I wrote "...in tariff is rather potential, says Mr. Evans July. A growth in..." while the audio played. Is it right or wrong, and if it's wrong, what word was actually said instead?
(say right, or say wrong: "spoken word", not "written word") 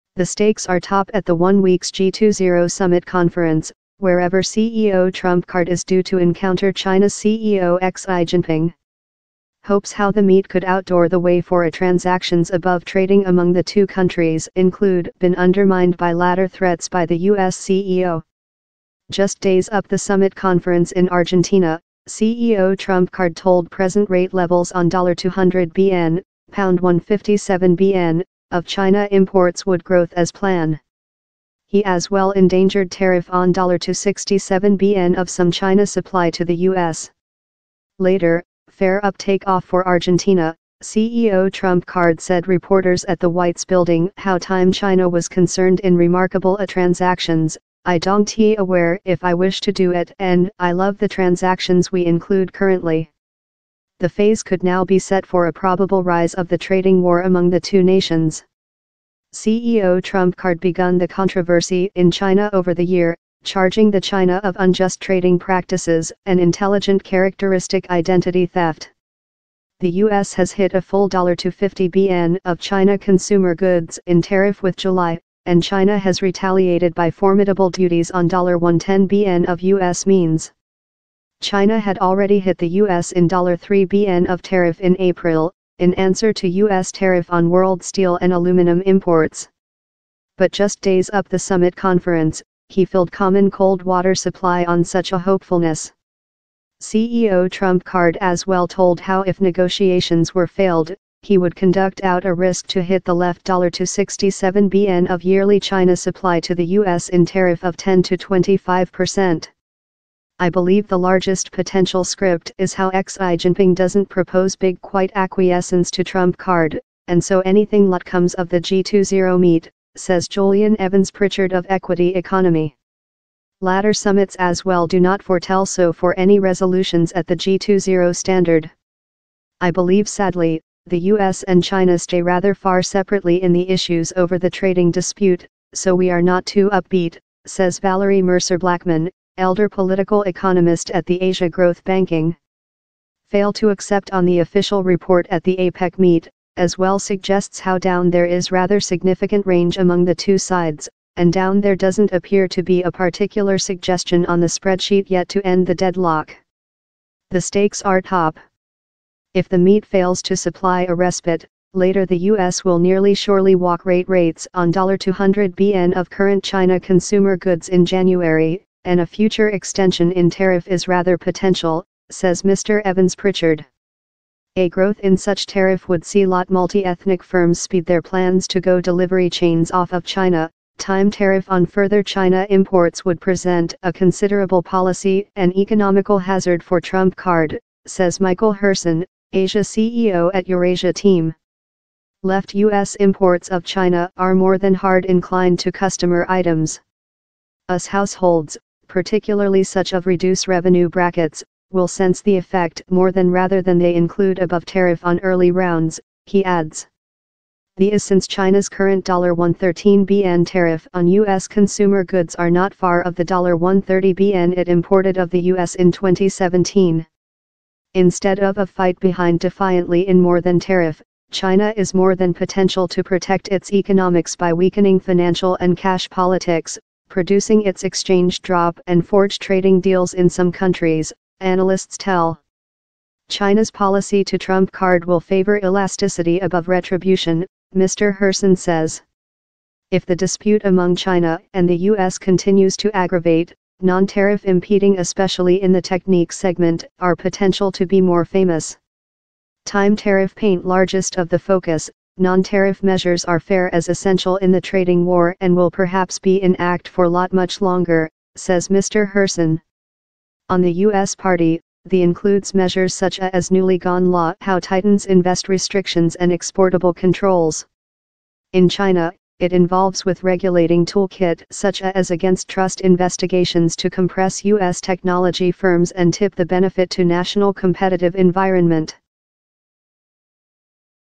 wrong: "Pritchard", not "July".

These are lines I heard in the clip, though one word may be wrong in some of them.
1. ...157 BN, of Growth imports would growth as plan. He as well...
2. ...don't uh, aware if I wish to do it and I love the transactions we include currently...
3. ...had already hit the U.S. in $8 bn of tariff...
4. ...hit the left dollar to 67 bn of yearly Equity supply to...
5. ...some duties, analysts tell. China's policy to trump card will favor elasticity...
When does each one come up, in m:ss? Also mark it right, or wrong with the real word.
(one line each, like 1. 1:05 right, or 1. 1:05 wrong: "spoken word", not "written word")
1. 0:26 wrong: "China", not "Growth"
2. 0:47 right
3. 1:21 wrong: "3", not "8"
4. 1:42 wrong: "China", not "Equity"
5. 3:50 wrong: "countries", not "duties".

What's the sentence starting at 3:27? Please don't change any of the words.
The is since China's current $113 BN tariff on U.S.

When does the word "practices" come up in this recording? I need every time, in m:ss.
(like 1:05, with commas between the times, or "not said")
1:05.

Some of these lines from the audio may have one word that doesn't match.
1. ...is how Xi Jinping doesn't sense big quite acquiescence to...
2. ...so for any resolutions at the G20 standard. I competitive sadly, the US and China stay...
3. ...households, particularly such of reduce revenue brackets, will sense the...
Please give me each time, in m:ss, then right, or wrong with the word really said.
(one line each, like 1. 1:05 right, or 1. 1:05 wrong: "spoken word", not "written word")
1. 1:52 wrong: "propose", not "sense"
2. 2:05 wrong: "believe", not "competitive"
3. 3:17 right.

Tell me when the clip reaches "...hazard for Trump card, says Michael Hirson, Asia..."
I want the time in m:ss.
3:06.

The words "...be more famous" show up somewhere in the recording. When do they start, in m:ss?
4:07.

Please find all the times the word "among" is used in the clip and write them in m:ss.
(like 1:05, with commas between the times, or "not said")
0:13, 0:57, 2:29, 4:00.